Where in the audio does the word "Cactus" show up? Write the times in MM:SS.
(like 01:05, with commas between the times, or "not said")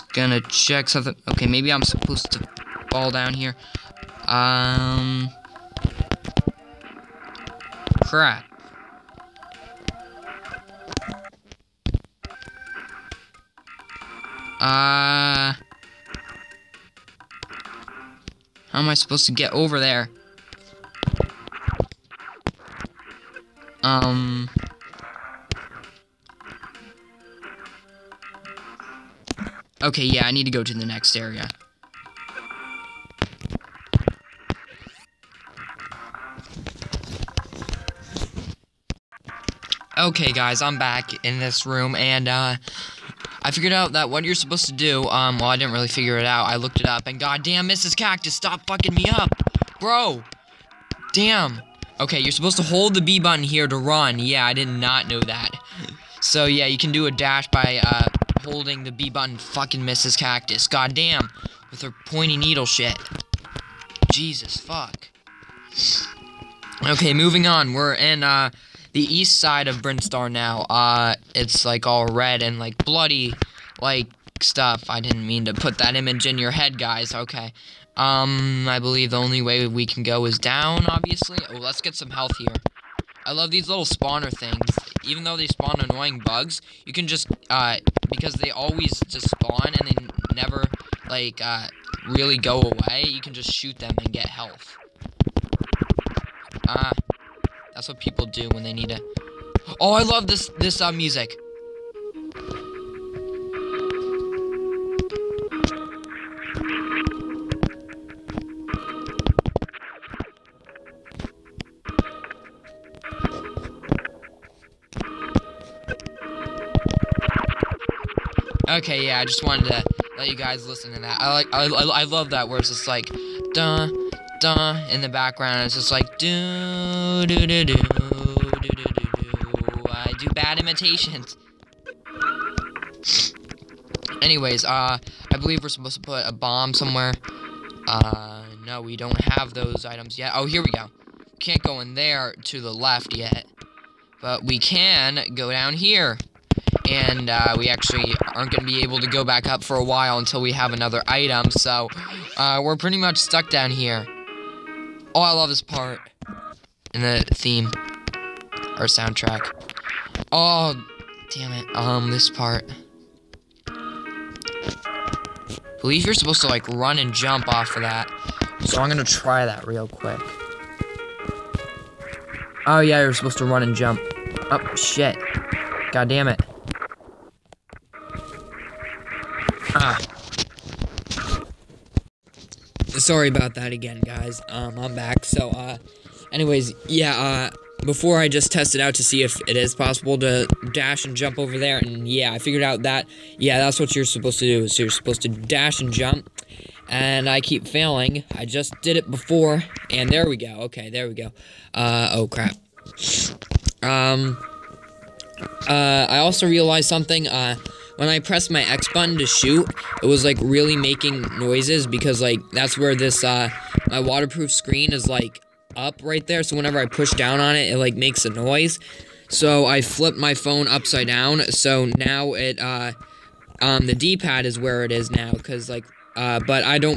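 00:47, 01:00.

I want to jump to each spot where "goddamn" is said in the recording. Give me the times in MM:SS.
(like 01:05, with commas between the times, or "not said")
00:47, 01:00.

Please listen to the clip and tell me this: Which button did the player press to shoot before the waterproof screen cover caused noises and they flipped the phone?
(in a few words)
X button.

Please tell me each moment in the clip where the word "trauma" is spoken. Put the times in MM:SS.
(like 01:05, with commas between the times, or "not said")
not said.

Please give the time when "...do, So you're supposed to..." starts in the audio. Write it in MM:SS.
03:14.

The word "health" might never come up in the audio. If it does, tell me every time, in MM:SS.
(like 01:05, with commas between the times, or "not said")
01:22, 01:34.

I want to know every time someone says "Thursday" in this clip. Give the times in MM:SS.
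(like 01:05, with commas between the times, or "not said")
not said.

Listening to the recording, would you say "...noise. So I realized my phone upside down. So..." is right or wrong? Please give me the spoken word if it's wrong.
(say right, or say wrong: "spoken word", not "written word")
wrong: "flipped", not "realized".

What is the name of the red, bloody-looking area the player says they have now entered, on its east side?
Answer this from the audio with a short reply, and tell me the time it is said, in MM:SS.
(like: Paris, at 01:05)
Brinstar, at 01:09.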